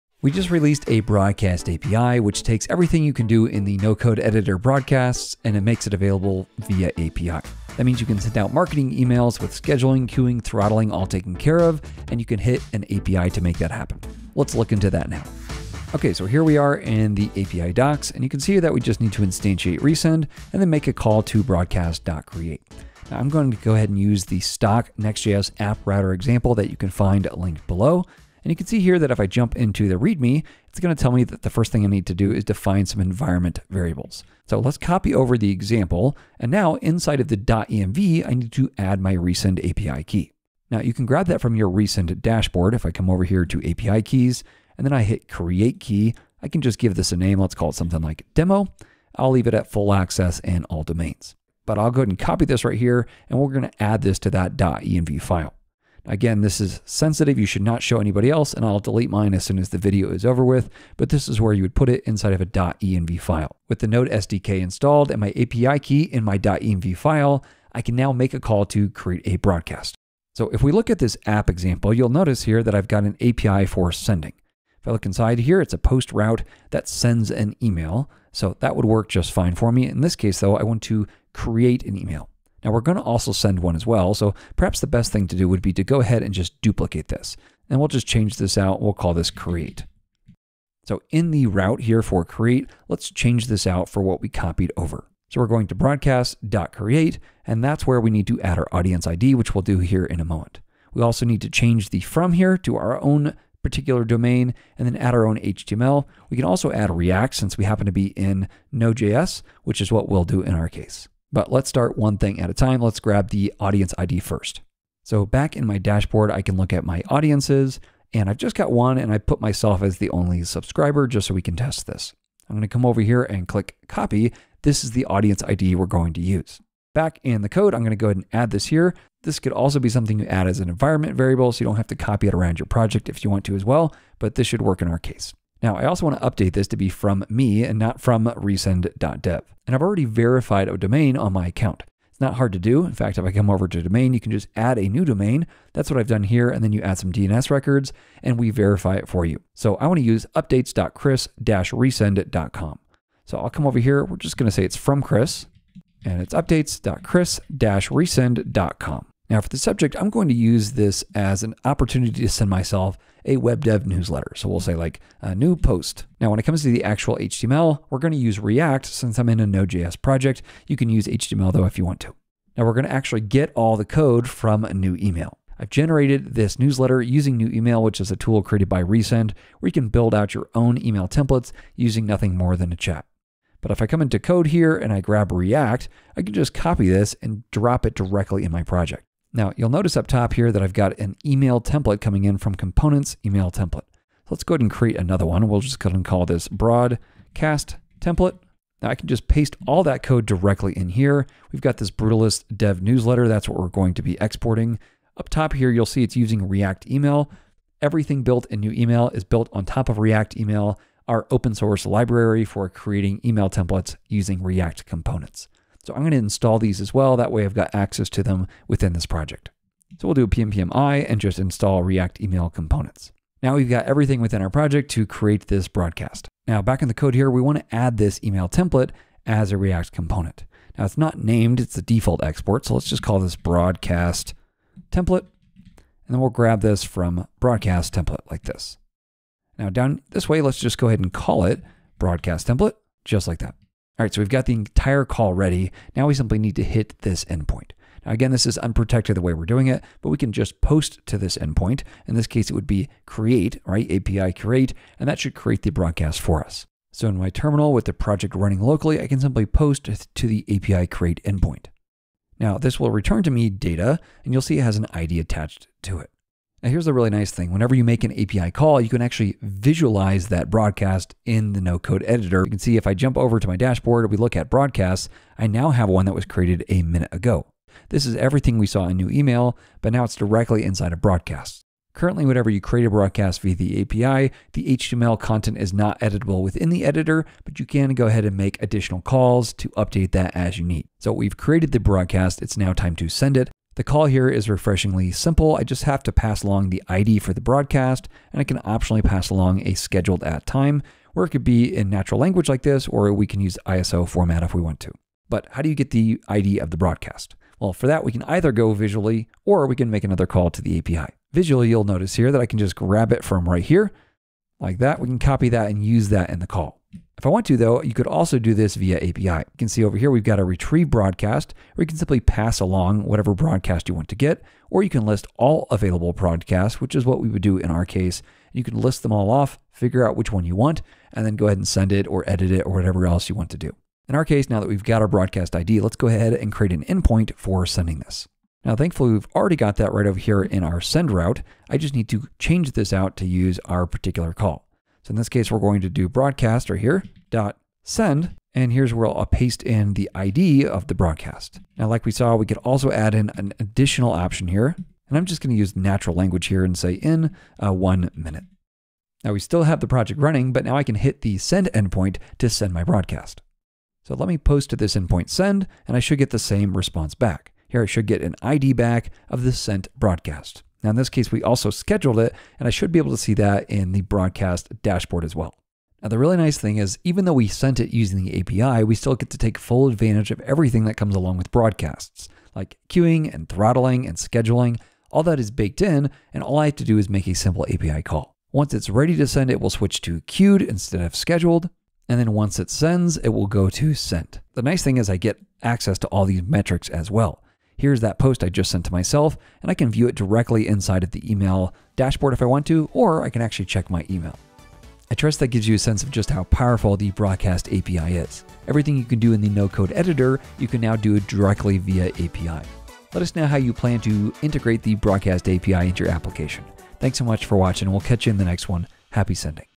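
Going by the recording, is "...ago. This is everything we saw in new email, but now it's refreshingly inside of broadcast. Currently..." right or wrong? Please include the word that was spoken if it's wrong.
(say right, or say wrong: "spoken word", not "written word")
wrong: "directly", not "refreshingly".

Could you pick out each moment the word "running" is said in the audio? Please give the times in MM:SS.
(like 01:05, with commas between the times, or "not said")
04:18, 06:00.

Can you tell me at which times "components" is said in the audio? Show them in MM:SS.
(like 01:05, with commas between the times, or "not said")
03:12, 03:34, 03:42, 03:49.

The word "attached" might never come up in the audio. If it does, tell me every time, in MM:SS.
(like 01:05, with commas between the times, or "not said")
04:25.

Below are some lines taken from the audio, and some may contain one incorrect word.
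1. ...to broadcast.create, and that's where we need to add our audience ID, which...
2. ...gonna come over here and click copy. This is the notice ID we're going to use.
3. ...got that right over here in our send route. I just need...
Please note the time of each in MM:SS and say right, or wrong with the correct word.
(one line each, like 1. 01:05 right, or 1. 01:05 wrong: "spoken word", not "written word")
1. 01:35 right
2. 02:02 wrong: "audience", not "notice"
3. 05:39 right.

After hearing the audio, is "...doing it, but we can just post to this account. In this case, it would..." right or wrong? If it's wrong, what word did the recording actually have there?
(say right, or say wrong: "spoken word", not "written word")
wrong: "endpoint", not "account".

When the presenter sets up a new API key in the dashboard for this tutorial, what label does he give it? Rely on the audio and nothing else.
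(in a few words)
demo.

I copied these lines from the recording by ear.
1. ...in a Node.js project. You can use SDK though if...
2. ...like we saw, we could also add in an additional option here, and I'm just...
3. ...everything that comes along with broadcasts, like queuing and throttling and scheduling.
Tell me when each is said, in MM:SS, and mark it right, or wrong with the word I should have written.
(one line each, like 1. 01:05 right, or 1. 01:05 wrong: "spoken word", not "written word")
1. 02:49 wrong: "HTML", not "SDK"
2. 05:51 right
3. 06:20 right.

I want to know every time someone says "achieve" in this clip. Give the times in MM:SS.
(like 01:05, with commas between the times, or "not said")
not said.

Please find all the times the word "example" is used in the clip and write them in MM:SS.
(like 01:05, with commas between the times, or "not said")
00:26, 00:35, 01:11.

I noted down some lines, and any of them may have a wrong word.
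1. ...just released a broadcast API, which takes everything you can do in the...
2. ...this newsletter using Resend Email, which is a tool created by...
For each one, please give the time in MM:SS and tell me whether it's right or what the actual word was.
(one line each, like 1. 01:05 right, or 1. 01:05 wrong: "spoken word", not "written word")
1. 00:00 right
2. 02:56 wrong: "New", not "Resend".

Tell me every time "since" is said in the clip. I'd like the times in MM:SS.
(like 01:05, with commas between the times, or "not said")
01:47, 02:48.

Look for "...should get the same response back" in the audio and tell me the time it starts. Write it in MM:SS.
06:05.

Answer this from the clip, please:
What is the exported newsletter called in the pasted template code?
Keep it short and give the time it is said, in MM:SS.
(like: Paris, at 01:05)
Brutalist dev newsletter, at 03:21.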